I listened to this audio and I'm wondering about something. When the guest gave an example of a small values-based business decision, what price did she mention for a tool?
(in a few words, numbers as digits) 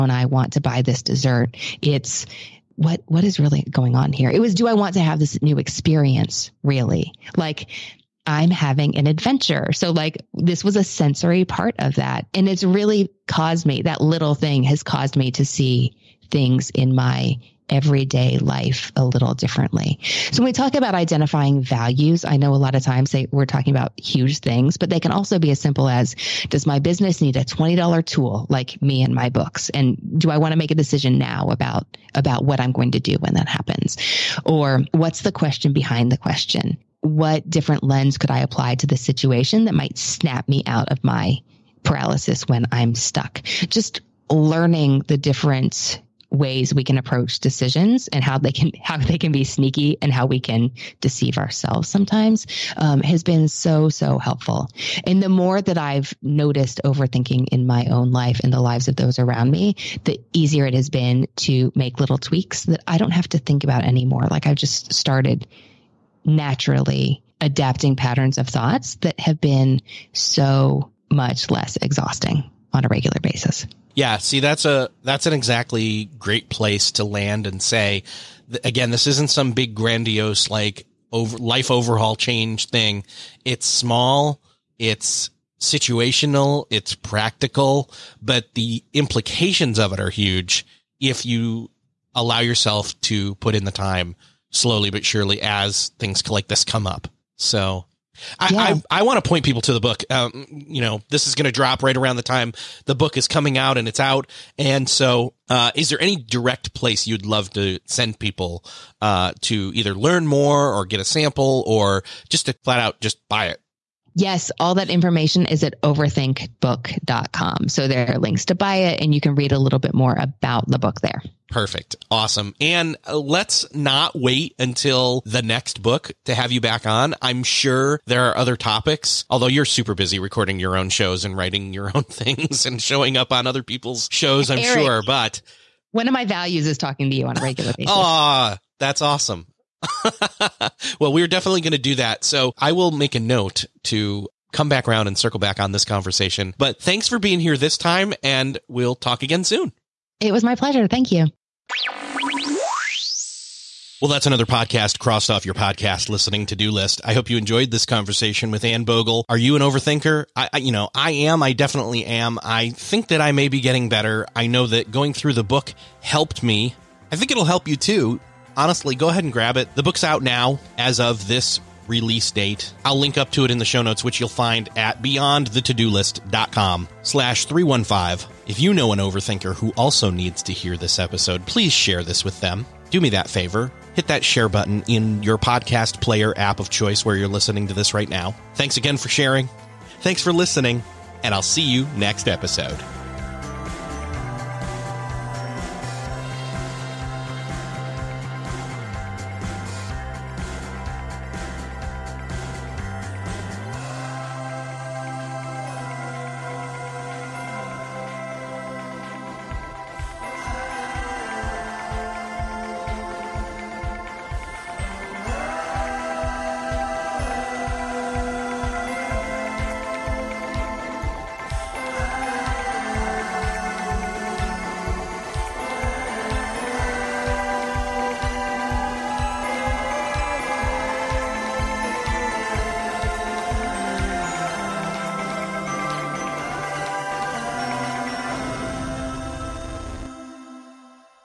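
$20.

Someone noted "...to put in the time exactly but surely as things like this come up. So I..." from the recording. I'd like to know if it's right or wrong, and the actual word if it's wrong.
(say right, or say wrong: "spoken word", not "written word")
wrong: "slowly", not "exactly".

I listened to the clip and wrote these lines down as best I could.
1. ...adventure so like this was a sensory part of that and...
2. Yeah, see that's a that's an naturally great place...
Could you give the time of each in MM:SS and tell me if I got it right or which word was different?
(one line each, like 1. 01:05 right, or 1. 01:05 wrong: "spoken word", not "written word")
1. 00:09 right
2. 01:13 wrong: "exactly", not "naturally".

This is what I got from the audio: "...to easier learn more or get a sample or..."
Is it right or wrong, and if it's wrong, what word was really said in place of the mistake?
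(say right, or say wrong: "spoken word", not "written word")
wrong: "either", not "easier".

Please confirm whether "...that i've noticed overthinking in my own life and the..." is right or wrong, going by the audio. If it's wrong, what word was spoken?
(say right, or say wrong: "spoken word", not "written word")
right.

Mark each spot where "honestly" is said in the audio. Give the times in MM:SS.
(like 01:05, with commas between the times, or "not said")
02:48.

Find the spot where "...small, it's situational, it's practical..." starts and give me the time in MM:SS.
01:23.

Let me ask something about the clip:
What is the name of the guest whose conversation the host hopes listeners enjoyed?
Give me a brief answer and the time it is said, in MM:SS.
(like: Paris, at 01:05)
Anne Bogel, at 02:38.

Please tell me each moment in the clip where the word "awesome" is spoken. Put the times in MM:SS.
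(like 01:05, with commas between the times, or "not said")
02:02, 02:19.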